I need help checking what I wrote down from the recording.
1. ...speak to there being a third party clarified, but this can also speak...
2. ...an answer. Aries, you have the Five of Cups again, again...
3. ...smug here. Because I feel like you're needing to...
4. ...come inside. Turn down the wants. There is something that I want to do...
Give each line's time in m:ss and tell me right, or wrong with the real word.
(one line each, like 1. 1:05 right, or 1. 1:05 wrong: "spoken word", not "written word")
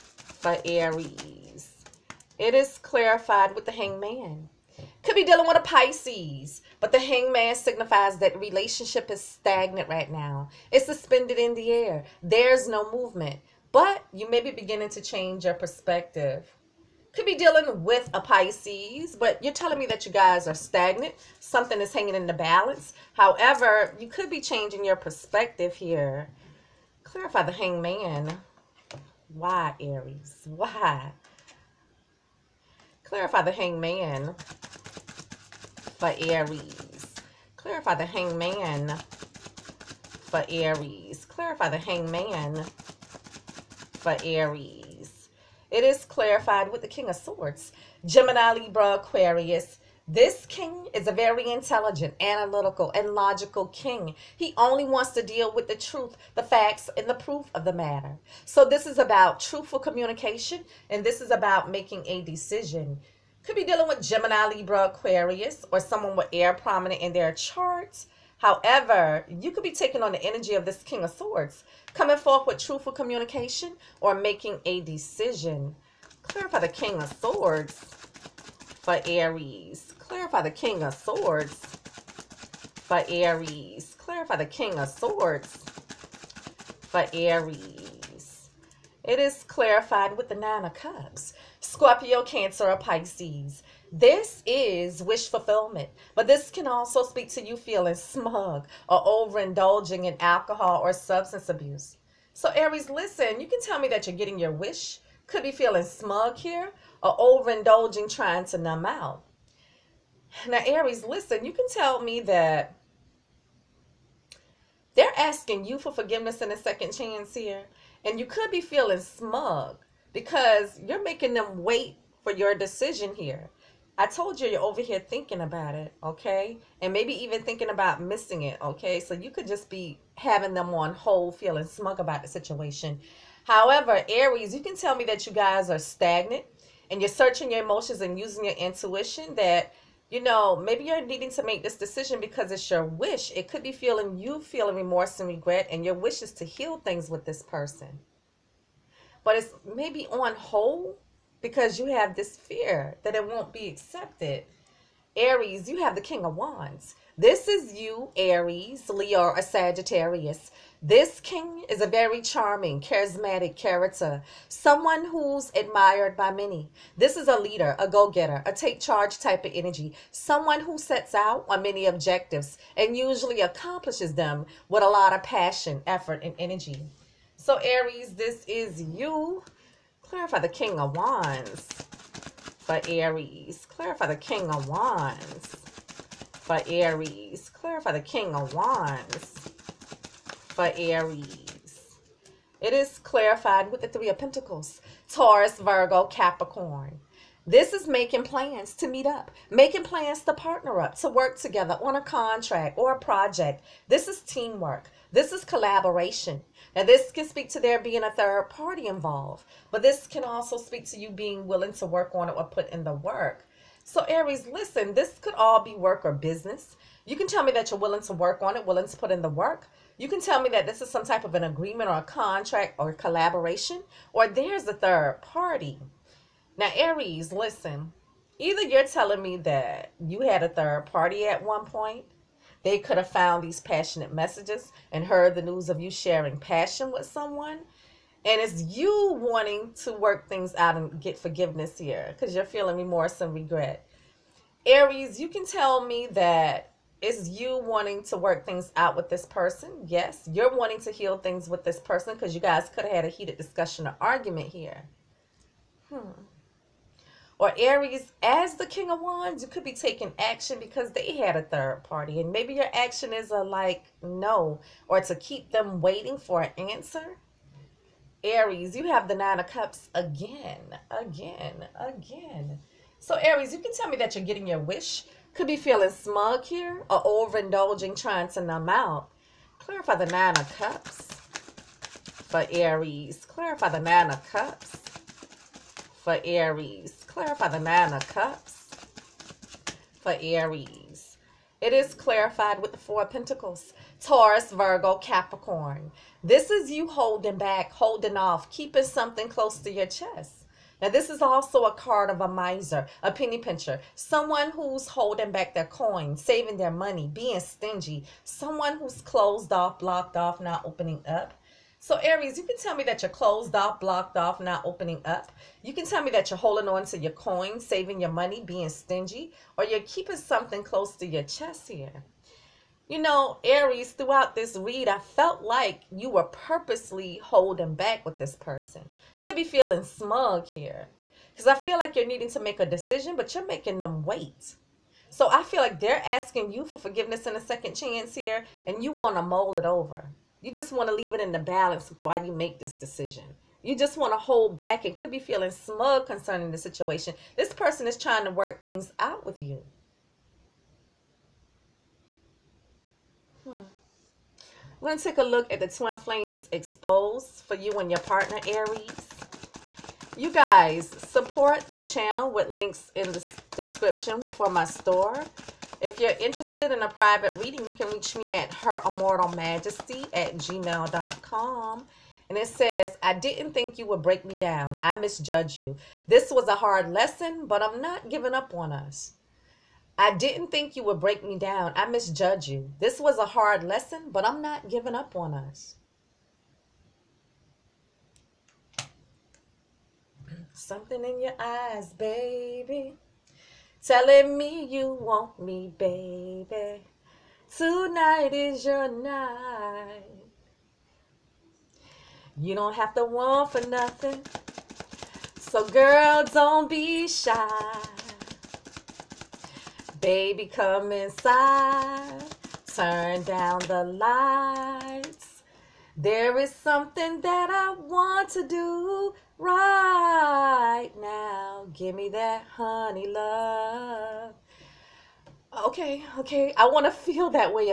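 1. 3:27 wrong: "involved", not "clarified"
2. 4:26 wrong: "Nine", not "Five"
3. 5:29 right
4. 6:50 wrong: "lights", not "wants".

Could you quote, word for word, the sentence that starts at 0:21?
Something is hanging in the balance.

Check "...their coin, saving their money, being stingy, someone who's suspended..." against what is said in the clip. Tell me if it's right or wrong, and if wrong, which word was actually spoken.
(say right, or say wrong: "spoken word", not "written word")
wrong: "closed", not "suspended".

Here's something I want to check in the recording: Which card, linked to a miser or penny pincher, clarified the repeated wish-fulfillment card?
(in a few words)
Four Pentacles.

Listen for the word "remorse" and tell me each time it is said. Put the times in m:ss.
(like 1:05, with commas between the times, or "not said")
2:24, 4:02.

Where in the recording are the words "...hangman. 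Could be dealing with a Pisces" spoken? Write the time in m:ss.
0:03.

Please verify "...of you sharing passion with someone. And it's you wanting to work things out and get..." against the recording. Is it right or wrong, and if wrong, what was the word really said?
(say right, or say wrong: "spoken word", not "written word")
right.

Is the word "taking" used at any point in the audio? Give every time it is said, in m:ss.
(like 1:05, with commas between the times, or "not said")
1:09, 4:19.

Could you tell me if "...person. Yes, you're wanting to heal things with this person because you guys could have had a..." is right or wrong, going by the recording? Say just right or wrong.
right.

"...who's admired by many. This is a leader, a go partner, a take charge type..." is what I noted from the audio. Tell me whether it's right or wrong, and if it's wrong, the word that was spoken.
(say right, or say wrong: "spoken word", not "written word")
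wrong: "getter", not "partner".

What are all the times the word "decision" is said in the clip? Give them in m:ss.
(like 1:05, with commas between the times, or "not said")
1:02, 1:14, 2:02, 2:21, 5:32, 5:42.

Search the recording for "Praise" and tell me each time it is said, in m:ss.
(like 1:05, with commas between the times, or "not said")
not said.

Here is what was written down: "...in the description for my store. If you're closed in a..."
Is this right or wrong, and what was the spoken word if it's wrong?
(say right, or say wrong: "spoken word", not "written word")
wrong: "interested", not "closed".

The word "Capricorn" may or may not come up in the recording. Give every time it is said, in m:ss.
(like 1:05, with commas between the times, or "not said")
3:16, 4:54.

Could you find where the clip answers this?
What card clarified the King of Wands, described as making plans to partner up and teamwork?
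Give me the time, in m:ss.
3:13.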